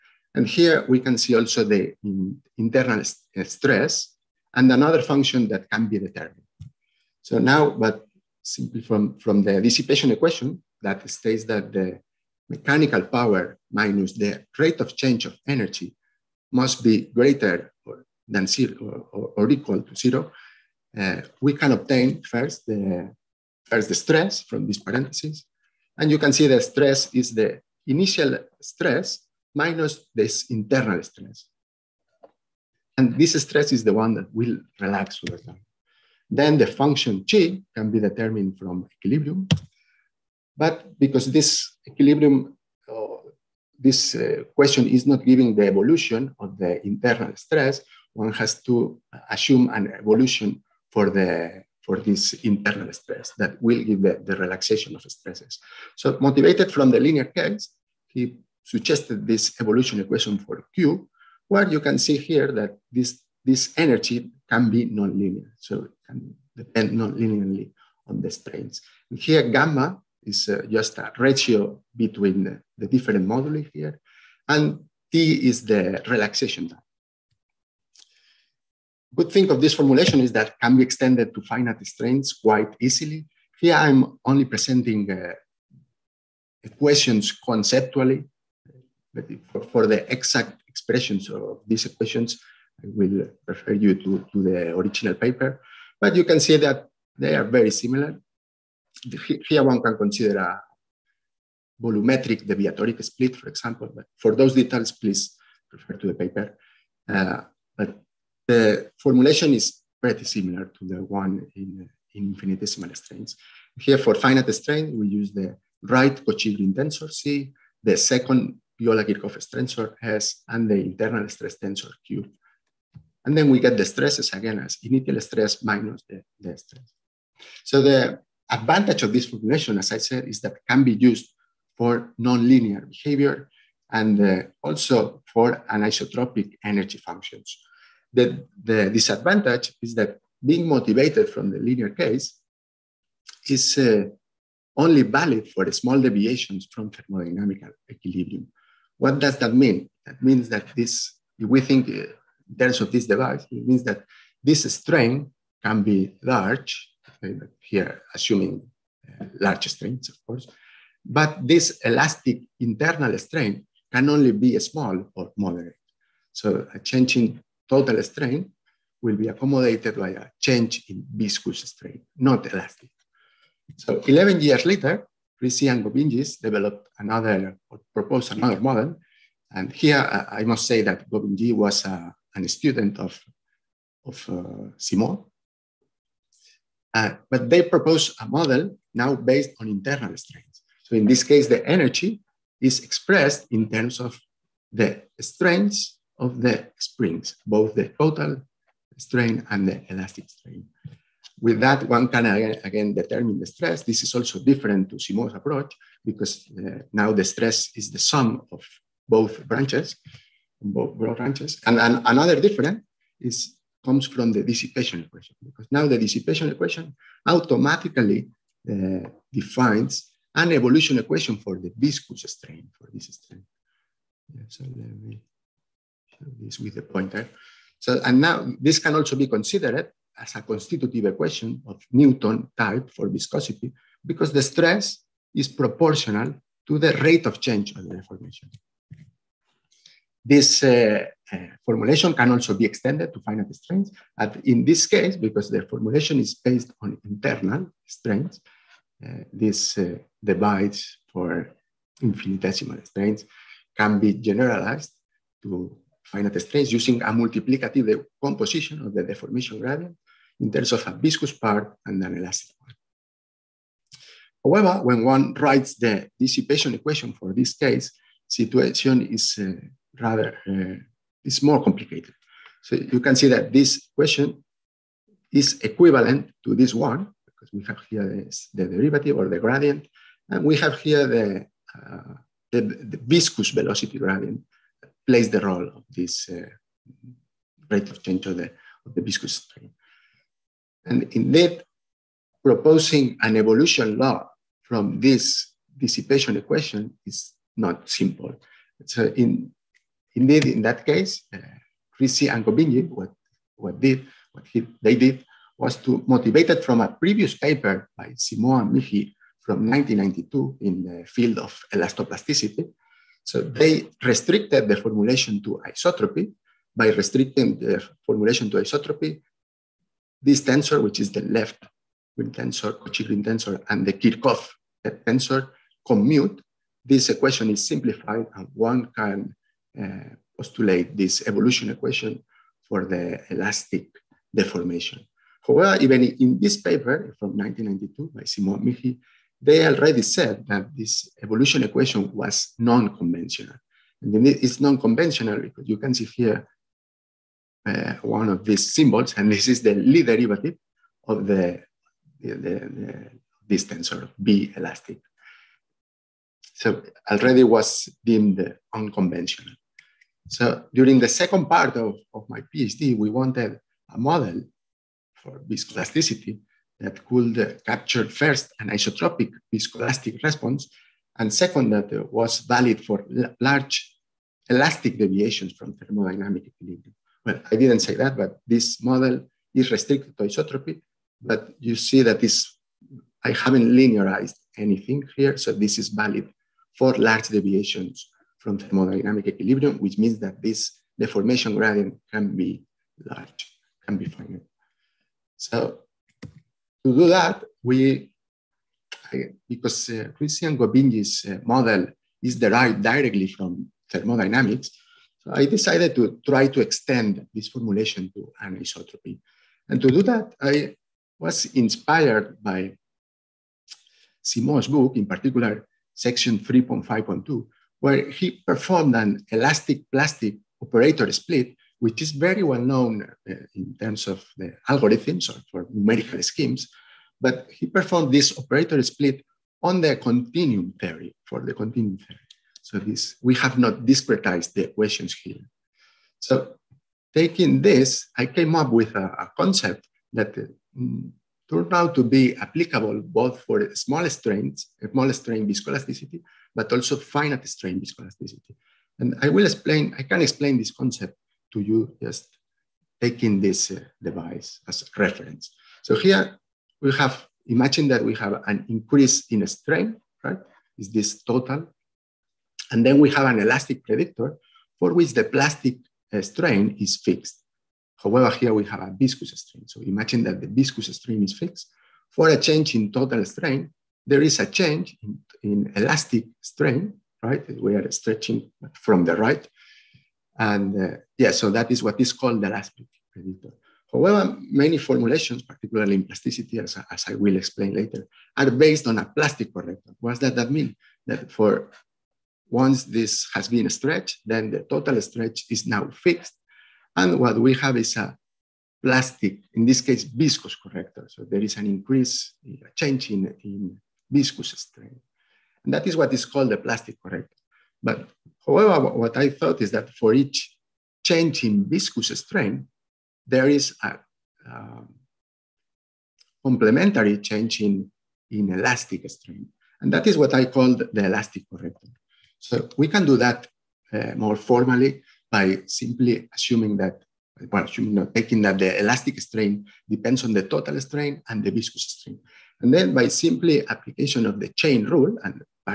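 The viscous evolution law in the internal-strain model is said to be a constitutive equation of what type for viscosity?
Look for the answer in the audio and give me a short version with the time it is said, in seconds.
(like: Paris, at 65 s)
Newton type, at 231 s.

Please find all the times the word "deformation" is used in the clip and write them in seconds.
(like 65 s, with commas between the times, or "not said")
237 s, 259 s, 334 s, 390 s.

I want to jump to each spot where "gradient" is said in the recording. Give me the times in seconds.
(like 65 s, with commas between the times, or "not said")
259 s, 279 s, 283 s, 391 s.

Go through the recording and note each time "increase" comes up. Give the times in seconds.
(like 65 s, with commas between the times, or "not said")
458 s, 501 s.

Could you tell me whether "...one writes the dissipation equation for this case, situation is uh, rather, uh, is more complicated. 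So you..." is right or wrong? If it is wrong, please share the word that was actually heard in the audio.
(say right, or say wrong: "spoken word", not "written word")
right.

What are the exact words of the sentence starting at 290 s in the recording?
And indeed, proposing an evolution law from this dissipation equation is not simple.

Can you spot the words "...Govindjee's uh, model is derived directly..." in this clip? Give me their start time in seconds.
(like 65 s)
400 s.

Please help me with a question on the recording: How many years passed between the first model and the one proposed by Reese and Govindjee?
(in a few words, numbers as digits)
11.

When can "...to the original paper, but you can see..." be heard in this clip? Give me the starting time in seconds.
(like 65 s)
94 s.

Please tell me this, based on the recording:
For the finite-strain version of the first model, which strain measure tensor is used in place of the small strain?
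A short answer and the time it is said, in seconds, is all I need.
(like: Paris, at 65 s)
right Cauchy-Green tensor, at 115 s.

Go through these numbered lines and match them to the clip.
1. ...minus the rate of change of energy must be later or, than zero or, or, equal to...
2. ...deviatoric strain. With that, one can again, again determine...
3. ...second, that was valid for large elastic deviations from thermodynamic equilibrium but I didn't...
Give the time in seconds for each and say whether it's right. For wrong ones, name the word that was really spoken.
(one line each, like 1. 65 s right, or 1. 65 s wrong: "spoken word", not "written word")
1. 13 s wrong: "greater", not "later"
2. 199 s wrong: "elastic", not "deviatoric"
3. 371 s right.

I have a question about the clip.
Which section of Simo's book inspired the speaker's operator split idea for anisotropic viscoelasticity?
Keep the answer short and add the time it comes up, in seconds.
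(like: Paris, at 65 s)
3.5.2, at 415 s.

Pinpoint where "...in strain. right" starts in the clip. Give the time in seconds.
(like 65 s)
459 s.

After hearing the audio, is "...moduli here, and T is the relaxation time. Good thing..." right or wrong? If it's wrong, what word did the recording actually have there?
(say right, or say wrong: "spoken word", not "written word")
right.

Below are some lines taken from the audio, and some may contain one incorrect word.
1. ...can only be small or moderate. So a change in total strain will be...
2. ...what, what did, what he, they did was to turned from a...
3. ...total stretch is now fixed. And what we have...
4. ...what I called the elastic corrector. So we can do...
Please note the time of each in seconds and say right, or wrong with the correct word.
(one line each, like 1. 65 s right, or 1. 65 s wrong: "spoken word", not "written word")
1. 163 s right
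2. 302 s wrong: "motivated", not "turned"
3. 494 s right
4. 520 s right.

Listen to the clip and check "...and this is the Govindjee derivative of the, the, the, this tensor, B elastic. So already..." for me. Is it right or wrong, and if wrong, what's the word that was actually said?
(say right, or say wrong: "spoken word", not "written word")
wrong: "Lie", not "Govindjee".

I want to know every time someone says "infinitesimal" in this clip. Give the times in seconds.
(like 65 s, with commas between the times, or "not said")
112 s, 252 s.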